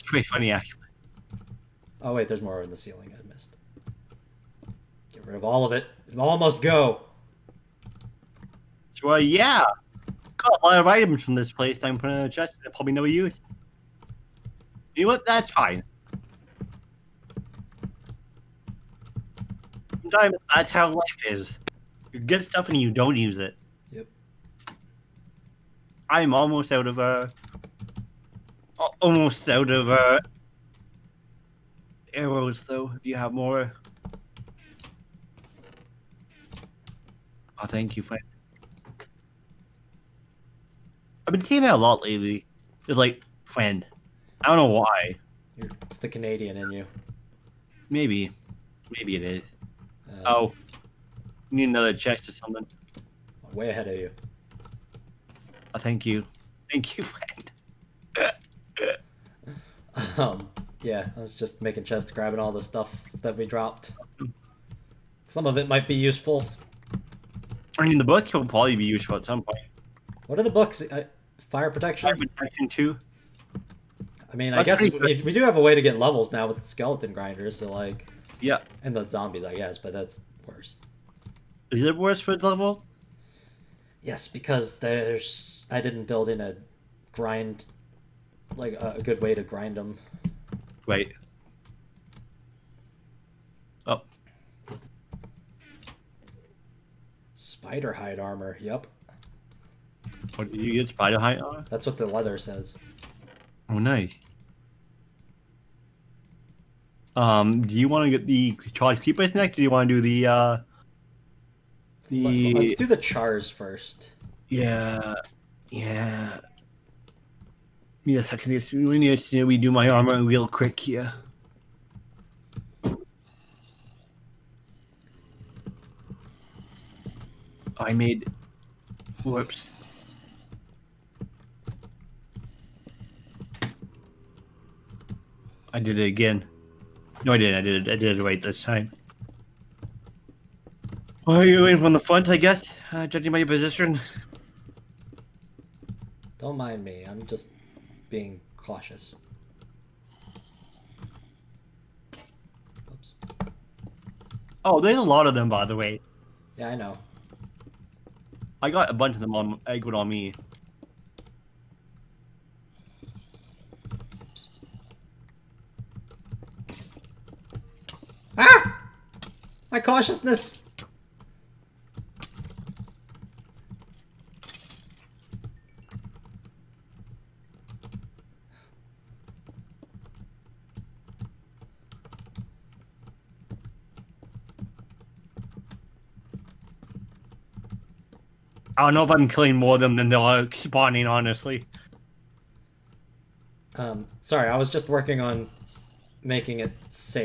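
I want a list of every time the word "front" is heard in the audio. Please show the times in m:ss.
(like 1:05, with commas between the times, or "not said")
2:21.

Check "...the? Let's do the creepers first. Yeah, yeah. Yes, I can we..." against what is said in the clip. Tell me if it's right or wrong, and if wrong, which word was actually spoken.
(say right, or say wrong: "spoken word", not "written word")
wrong: "chars", not "creepers".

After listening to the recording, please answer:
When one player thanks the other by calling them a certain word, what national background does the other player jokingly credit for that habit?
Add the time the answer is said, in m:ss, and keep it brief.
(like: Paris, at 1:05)
Canadian, at 0:46.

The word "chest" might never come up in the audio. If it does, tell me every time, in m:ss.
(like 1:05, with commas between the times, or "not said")
0:12, 0:51, 1:01.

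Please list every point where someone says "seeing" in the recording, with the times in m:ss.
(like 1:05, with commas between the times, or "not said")
0:41.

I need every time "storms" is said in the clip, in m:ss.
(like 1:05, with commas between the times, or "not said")
not said.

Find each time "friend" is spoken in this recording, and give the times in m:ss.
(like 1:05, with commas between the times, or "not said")
0:38, 0:43, 0:58.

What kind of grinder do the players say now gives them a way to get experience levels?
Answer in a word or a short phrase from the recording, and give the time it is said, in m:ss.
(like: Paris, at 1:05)
Skeleton grinders, at 1:16.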